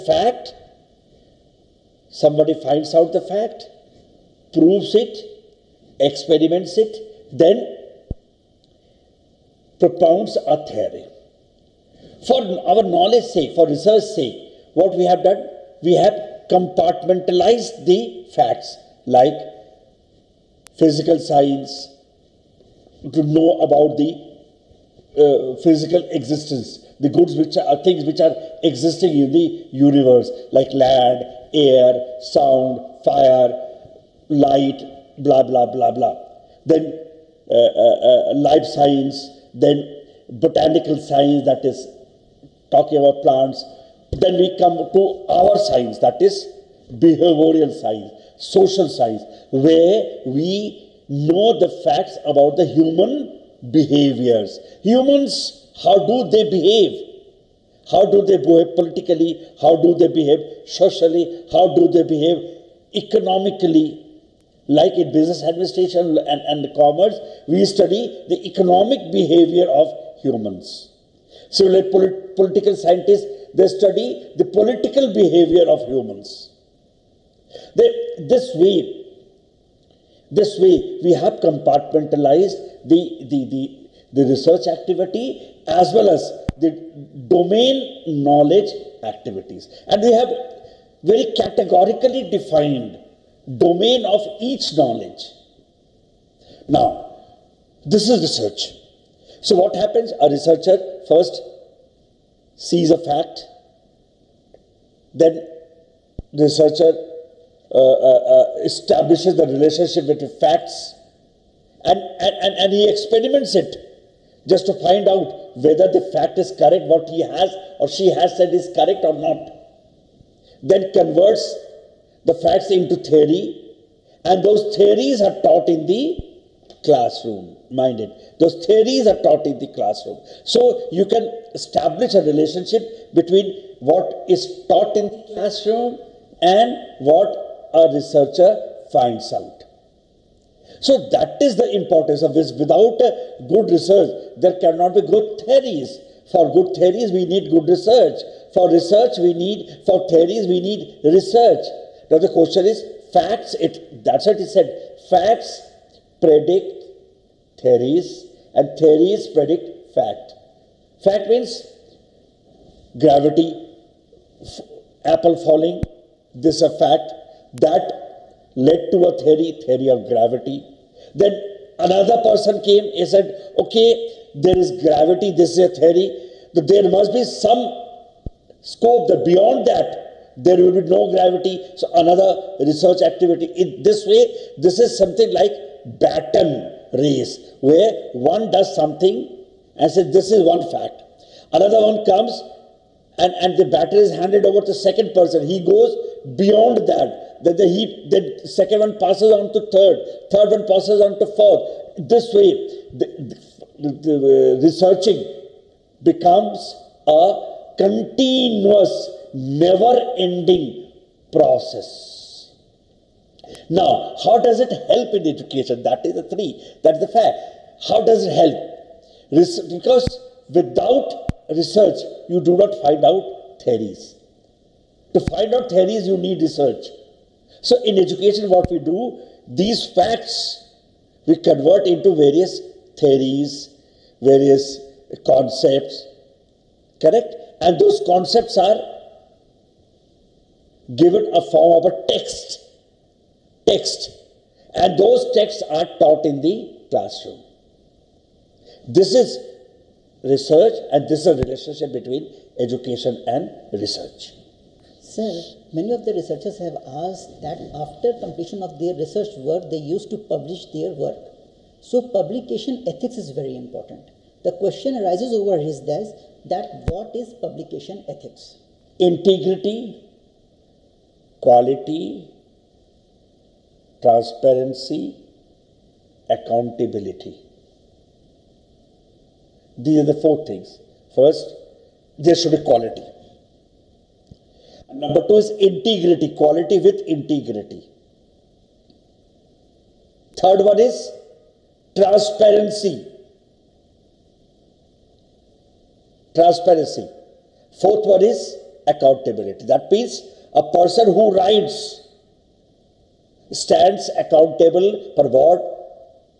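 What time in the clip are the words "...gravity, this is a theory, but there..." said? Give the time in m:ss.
2:54.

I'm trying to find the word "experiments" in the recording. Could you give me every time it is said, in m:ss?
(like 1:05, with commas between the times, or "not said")
0:06, 1:52.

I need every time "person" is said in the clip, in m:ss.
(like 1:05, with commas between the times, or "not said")
2:52, 3:15, 5:00.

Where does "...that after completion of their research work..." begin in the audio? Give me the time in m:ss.
4:17.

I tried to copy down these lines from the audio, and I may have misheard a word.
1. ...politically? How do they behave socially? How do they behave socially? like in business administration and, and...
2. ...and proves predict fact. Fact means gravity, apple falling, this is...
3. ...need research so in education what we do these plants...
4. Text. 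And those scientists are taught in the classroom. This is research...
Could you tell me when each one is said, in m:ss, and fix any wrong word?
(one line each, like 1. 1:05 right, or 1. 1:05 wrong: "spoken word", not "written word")
1. 0:58 wrong: "economically", not "socially"
2. 2:38 wrong: "theories", not "proves"
3. 3:46 wrong: "facts", not "plants"
4. 4:03 wrong: "texts", not "scientists".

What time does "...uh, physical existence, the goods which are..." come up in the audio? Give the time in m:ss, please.
0:25.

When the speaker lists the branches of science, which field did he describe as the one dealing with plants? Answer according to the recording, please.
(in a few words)
Botanical science.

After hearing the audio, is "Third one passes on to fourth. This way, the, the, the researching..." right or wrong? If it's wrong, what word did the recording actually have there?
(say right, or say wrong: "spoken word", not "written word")
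right.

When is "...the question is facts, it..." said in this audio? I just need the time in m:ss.
2:32.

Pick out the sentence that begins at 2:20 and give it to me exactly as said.
So that is the importance of this.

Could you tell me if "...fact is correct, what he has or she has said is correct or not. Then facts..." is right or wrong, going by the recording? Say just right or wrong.
wrong.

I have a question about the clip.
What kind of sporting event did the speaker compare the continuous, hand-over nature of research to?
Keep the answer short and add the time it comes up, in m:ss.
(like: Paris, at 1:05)
Baton race, at 3:06.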